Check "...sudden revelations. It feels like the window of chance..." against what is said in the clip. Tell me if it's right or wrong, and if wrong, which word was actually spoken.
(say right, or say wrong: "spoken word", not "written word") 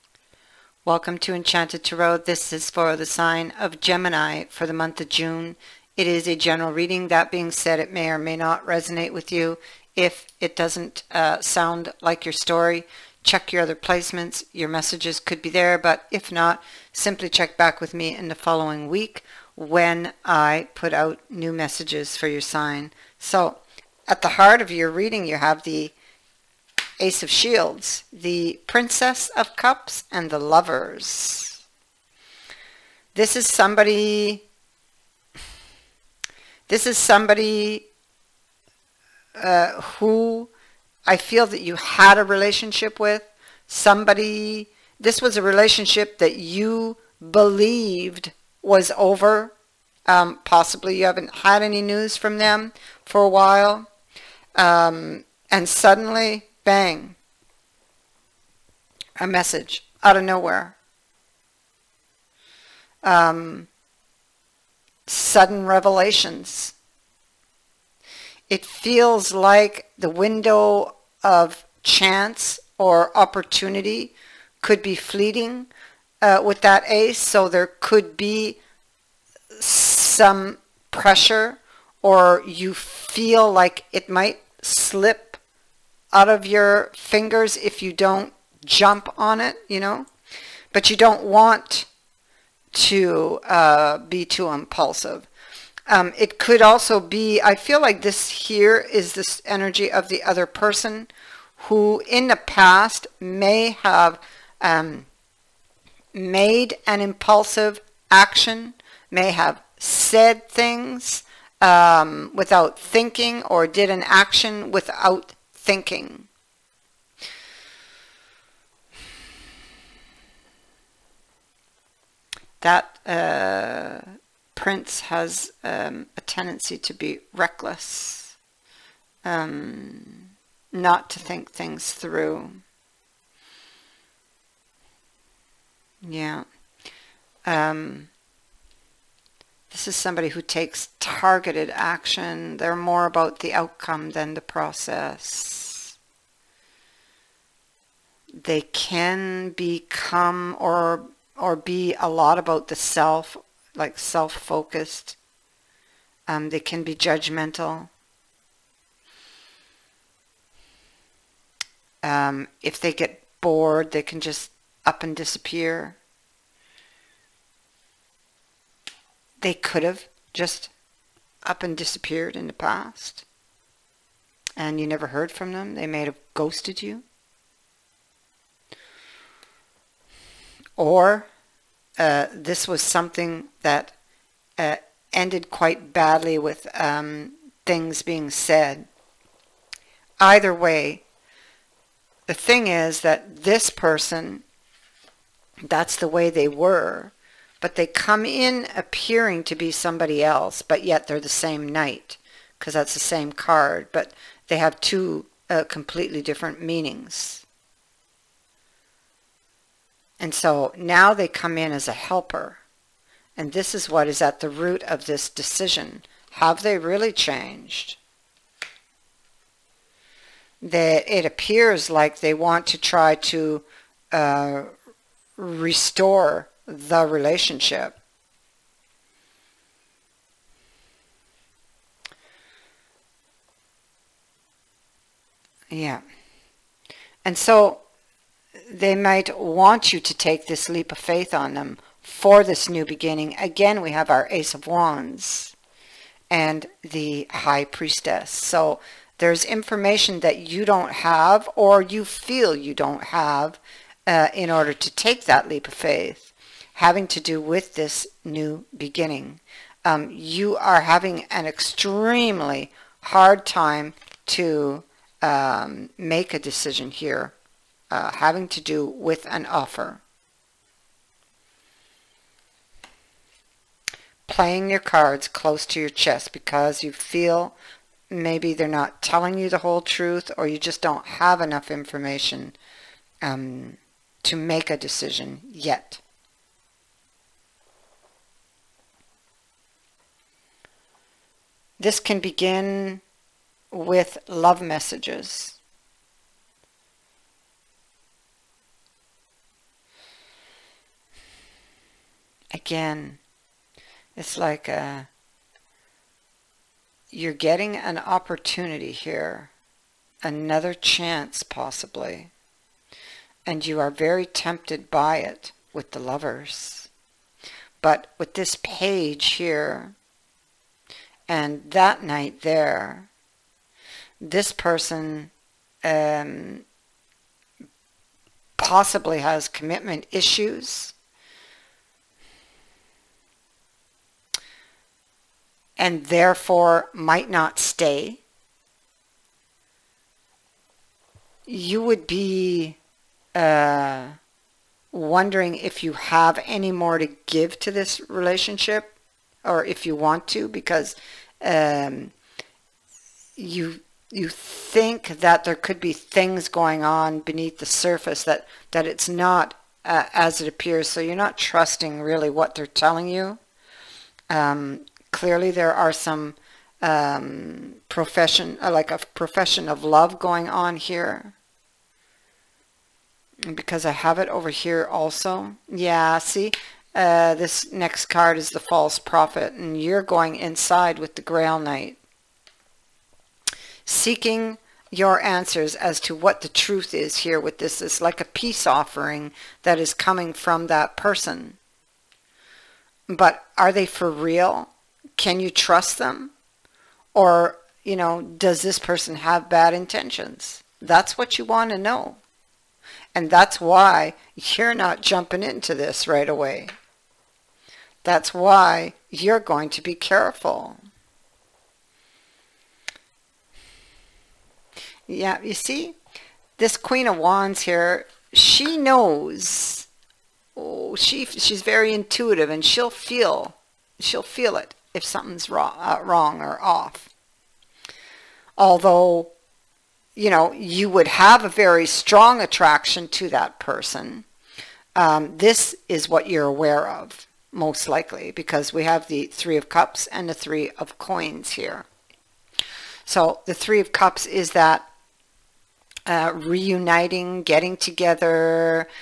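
right.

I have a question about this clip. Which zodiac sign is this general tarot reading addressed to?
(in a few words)
Gemini.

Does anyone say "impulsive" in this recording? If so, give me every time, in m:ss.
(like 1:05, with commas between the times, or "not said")
1:34, 1:47.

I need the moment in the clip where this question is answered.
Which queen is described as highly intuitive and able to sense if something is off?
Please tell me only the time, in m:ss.
6:56.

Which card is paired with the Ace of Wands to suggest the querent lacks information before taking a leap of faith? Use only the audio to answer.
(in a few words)
The High Priestess.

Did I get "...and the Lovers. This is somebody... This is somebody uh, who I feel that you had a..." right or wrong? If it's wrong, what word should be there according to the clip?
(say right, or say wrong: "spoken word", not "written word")
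right.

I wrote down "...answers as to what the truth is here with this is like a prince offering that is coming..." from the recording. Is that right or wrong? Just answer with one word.
wrong.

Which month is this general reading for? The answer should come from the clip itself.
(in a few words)
June.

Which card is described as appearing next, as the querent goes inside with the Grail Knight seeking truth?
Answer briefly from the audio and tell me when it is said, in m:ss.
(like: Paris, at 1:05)
False Prophet, at 6:18.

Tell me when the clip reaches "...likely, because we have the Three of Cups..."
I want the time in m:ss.
7:17.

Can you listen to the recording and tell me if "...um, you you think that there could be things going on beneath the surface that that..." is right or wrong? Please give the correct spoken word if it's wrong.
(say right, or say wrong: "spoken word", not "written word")
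right.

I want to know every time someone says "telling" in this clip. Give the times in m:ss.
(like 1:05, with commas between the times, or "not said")
4:39, 6:02.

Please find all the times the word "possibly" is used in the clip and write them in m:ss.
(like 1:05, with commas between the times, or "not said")
0:50, 5:11, 5:28.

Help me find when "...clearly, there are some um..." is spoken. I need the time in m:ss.
6:05.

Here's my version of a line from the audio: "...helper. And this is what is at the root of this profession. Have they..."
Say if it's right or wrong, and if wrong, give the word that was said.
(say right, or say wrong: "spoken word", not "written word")
wrong: "decision", not "profession".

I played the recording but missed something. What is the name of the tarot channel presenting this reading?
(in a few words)
Enchanted Tarot.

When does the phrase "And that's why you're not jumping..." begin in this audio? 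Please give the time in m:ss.
6:43.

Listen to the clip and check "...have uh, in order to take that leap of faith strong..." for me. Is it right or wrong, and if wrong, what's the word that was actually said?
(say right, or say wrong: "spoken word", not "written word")
wrong: "having", not "strong".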